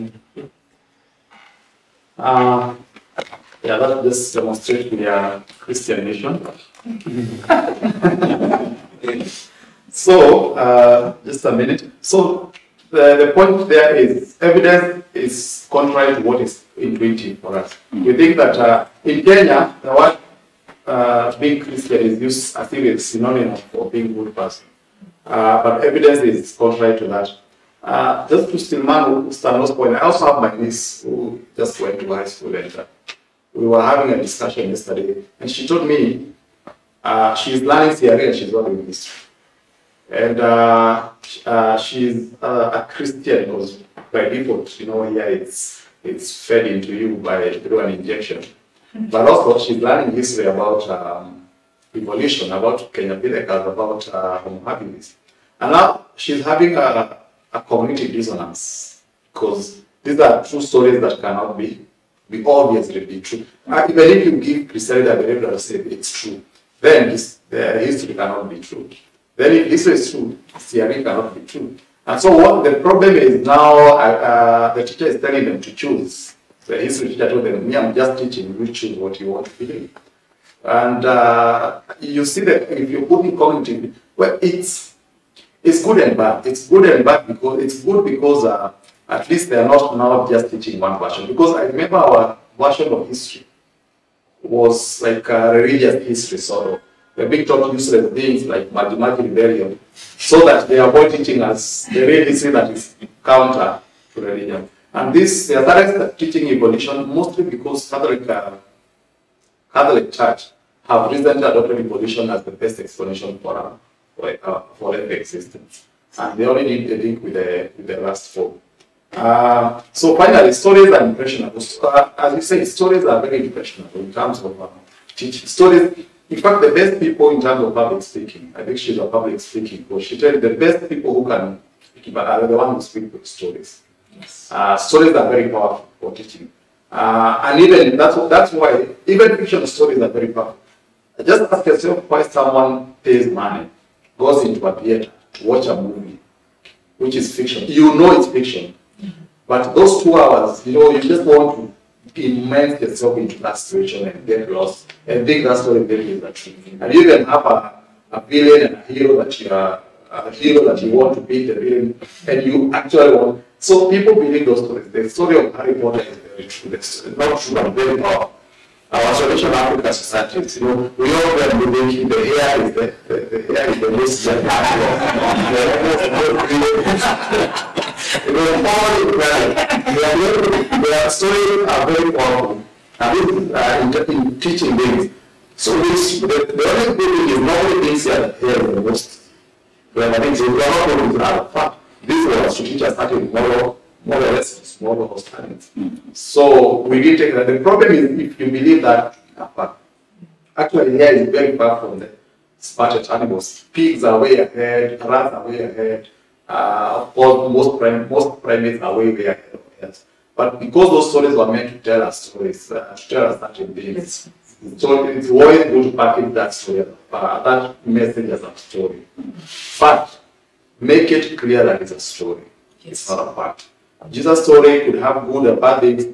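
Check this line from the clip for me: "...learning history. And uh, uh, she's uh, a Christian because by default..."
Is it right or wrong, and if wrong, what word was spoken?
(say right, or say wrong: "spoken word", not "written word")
right.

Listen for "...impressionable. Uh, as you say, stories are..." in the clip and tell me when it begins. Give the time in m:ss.
2:01.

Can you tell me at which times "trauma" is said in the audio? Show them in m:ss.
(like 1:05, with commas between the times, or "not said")
not said.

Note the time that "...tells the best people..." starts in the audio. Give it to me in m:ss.
2:10.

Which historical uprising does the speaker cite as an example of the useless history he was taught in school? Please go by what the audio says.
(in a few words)
Maji Maji rebellion.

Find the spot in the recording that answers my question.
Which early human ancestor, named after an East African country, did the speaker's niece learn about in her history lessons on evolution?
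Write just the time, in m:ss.
0:52.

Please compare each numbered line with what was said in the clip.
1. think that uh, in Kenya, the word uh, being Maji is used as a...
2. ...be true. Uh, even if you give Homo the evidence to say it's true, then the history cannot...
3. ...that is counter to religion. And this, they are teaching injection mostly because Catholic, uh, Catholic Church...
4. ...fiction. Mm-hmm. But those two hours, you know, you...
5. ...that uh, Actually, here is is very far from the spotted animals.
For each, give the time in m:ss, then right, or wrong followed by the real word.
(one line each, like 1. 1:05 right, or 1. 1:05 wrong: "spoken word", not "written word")
1. 0:18 wrong: "Christian", not "Maji"
2. 1:03 wrong: "Griselda", not "Homo"
3. 1:42 wrong: "evolution", not "injection"
4. 2:28 right
5. 3:18 right.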